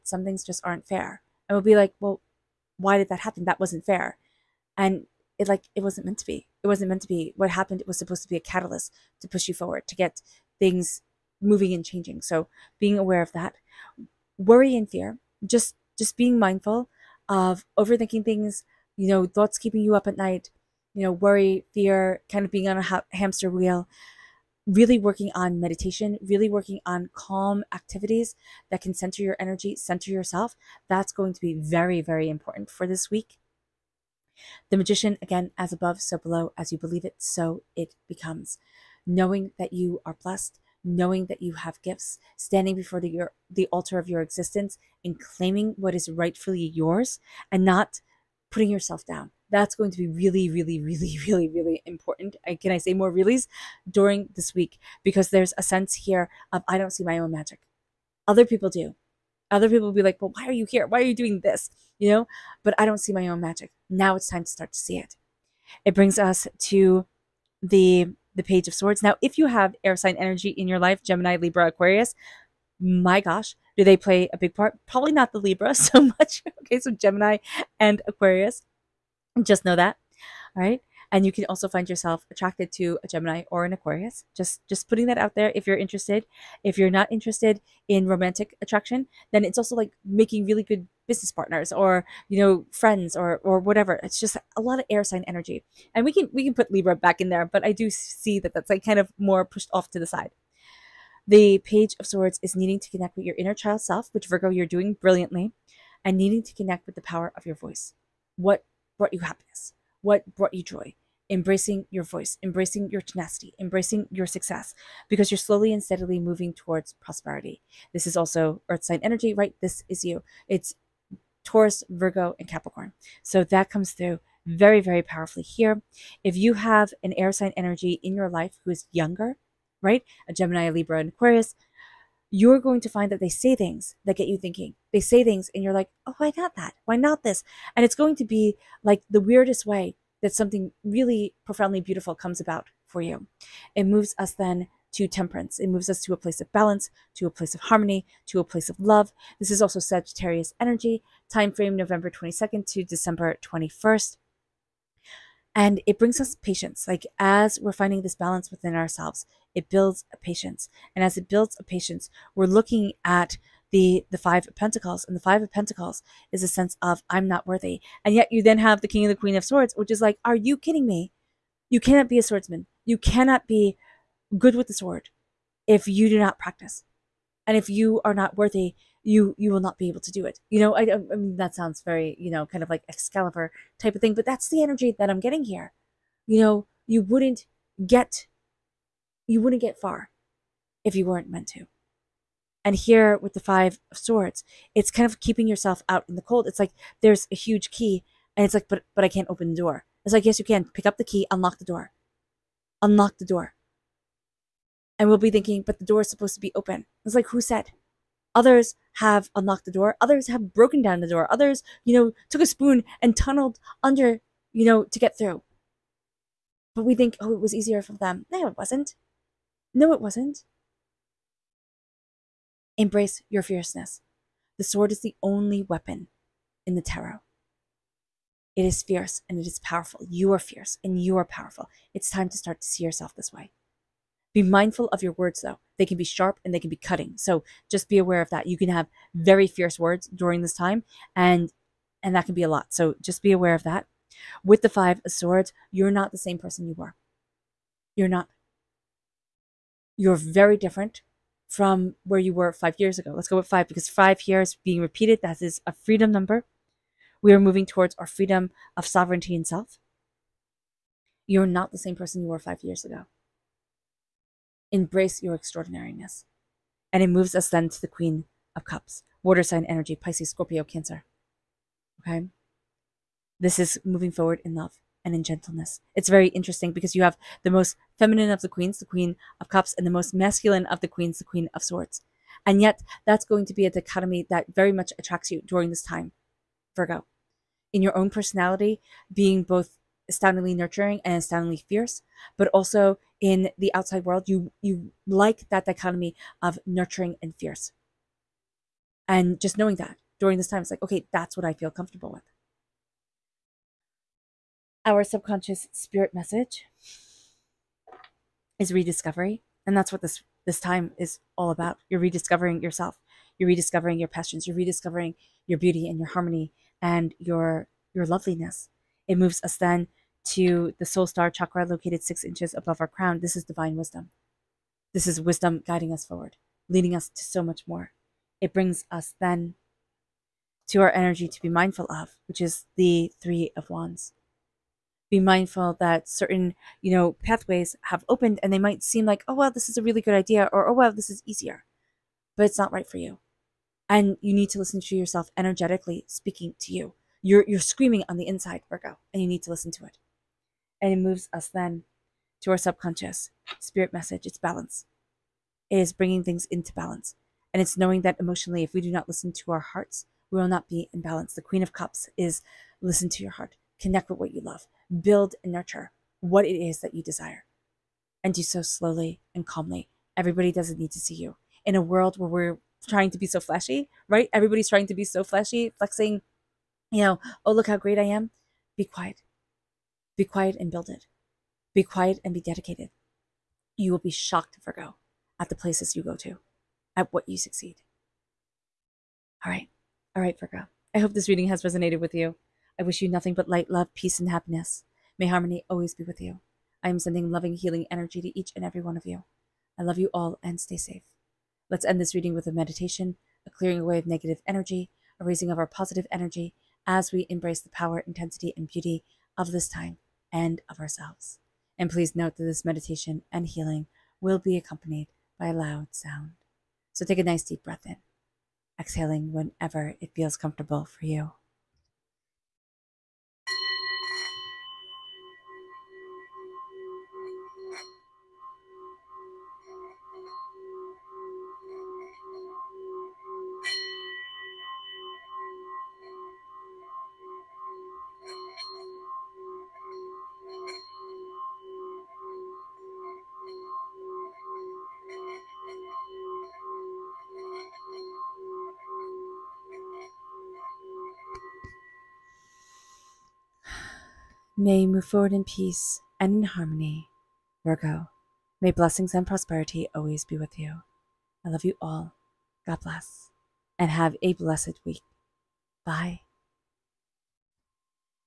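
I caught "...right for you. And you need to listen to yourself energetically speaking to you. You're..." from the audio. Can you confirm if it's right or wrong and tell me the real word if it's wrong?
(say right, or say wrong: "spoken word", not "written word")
right.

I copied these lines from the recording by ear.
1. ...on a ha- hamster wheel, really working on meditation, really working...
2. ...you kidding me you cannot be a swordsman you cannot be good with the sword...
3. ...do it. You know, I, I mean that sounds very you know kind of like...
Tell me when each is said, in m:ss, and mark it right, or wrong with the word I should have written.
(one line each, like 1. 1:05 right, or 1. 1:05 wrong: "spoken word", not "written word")
1. 0:22 right
2. 2:50 right
3. 3:00 right.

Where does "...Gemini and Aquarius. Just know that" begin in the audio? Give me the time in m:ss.
1:16.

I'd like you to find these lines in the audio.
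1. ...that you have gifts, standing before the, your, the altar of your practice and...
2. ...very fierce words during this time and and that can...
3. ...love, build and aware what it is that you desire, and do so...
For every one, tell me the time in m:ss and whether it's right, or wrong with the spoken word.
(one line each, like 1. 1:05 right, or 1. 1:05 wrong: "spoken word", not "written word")
1. 0:41 wrong: "existence", not "practice"
2. 3:59 right
3. 6:04 wrong: "nurture", not "aware".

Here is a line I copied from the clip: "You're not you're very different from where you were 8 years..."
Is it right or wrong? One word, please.
wrong.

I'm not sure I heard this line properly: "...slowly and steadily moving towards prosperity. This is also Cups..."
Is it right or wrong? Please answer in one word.
wrong.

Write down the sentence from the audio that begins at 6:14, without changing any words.
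Everybody's trying to be so flashy, flexing, you know, oh, look how great I am.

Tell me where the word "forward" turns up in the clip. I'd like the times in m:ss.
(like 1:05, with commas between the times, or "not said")
0:09, 4:34, 5:26, 7:35.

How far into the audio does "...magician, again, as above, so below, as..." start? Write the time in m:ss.
0:34.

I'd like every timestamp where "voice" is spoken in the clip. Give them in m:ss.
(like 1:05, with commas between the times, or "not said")
1:47, 1:52.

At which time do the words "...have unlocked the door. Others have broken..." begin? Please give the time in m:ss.
3:28.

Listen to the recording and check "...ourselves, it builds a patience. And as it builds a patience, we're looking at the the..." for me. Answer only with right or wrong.
right.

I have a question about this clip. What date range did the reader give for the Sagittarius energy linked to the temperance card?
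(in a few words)
November 22 to December 21.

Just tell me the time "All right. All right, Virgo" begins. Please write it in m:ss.
6:29.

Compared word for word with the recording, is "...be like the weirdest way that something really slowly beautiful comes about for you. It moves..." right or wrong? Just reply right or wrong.
wrong.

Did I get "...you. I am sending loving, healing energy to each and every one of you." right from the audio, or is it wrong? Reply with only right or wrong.
right.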